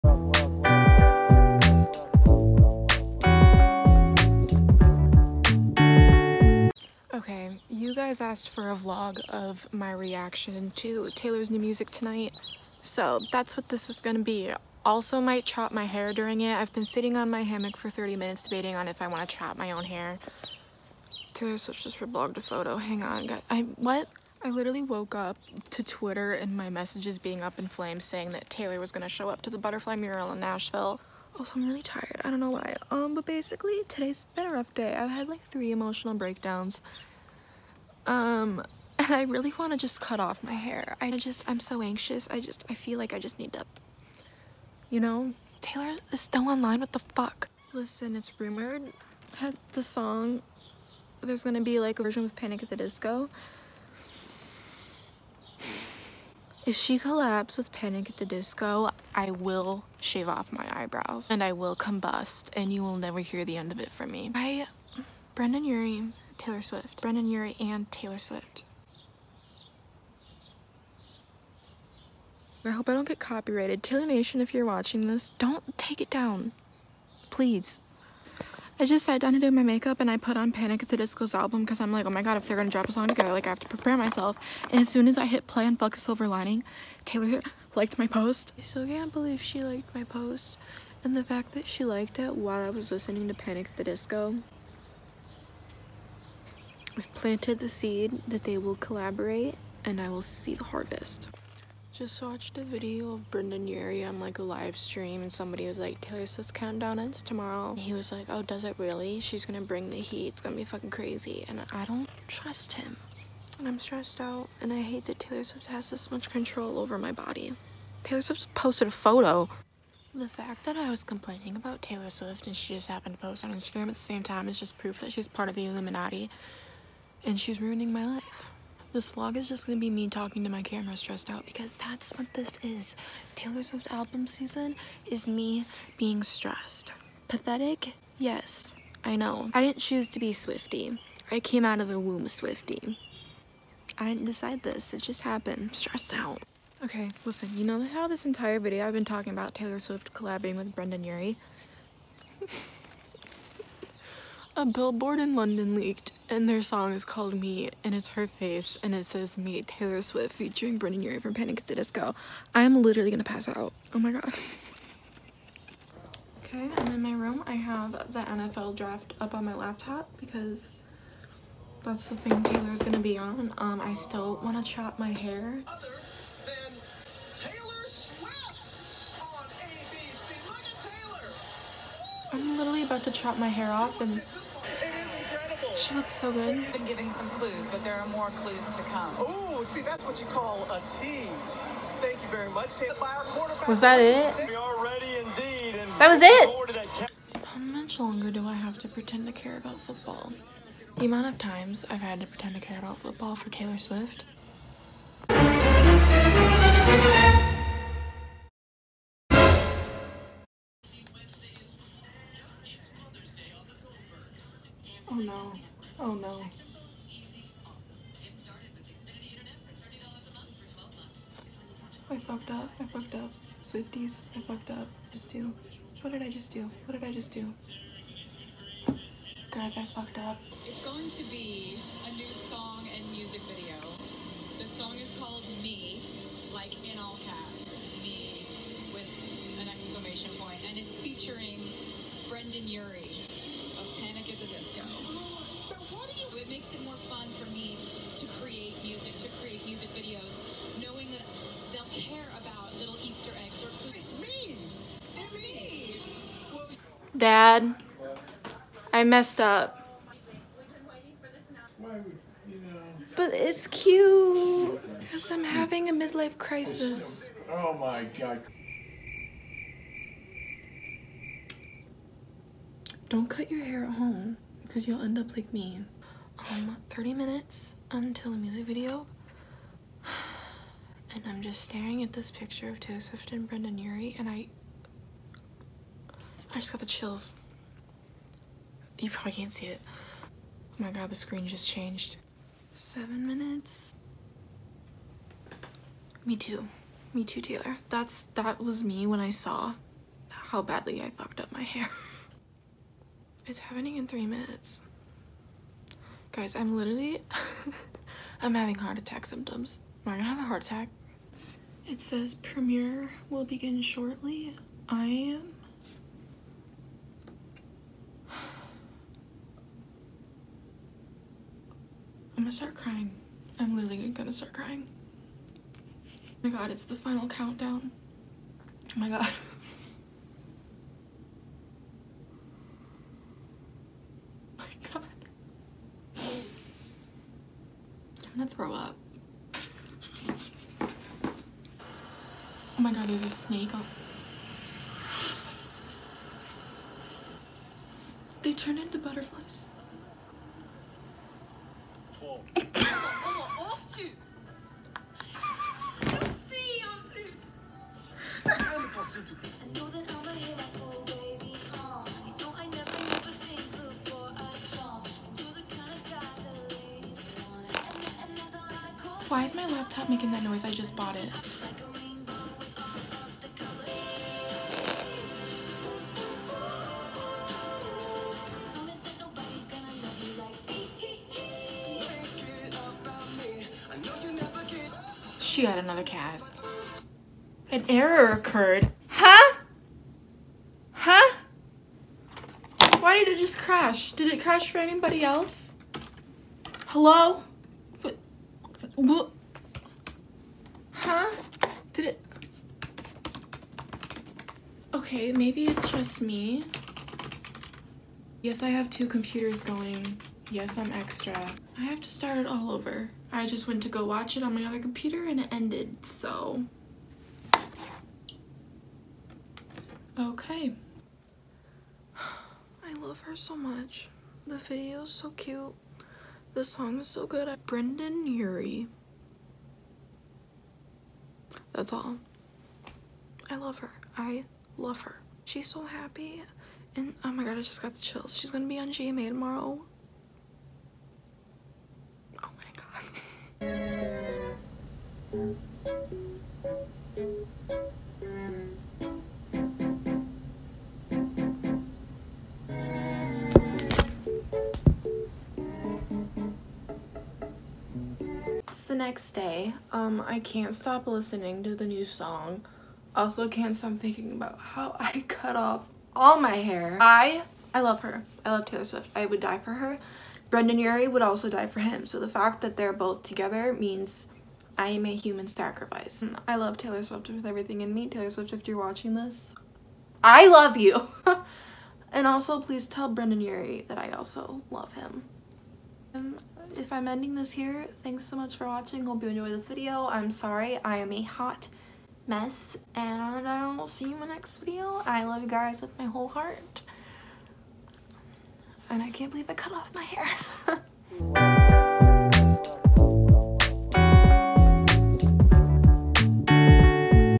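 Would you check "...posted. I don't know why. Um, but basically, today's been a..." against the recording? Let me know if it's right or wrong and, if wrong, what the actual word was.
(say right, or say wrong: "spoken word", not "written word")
wrong: "tired", not "posted".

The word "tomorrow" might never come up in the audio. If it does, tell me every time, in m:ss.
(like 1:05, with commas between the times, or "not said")
1:47, 7:19.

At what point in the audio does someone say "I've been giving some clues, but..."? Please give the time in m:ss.
3:06.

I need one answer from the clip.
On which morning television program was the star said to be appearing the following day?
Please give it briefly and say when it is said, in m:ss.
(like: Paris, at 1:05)
GMA, at 7:18.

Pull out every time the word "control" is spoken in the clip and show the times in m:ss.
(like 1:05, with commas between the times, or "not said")
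1:56.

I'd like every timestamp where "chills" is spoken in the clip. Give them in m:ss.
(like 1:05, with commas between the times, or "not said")
4:46, 7:18.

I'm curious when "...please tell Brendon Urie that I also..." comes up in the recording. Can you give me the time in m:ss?
8:02.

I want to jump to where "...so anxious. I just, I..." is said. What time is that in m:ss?
0:41.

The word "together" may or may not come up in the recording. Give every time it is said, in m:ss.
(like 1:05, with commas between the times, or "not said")
1:23, 7:53.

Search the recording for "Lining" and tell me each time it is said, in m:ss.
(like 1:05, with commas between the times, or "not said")
1:26.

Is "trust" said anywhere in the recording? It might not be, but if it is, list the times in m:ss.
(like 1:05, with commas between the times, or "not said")
1:52.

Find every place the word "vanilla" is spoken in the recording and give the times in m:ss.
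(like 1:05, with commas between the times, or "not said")
not said.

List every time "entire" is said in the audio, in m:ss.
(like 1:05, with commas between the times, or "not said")
2:28.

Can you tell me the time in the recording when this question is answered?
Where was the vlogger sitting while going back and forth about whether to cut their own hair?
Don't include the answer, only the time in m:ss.
0:17.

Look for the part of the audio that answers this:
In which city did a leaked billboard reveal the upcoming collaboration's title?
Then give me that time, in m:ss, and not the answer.
2:35.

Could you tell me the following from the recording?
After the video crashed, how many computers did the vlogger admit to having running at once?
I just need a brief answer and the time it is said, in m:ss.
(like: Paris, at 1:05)
2, at 6:48.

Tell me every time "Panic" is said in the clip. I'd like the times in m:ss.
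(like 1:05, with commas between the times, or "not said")
0:52, 0:57, 1:20, 1:33, 2:41, 4:04.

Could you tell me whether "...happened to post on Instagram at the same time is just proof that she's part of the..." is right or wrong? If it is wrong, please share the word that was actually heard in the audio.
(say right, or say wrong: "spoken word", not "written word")
right.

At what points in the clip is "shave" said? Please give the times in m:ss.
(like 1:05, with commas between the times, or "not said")
0:59.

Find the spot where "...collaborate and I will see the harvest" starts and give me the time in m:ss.
1:38.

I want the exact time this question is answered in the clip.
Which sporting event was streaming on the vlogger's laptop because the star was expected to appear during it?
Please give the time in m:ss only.
2:48.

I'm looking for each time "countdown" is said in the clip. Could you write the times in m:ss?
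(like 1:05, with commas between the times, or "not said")
1:46, 5:27.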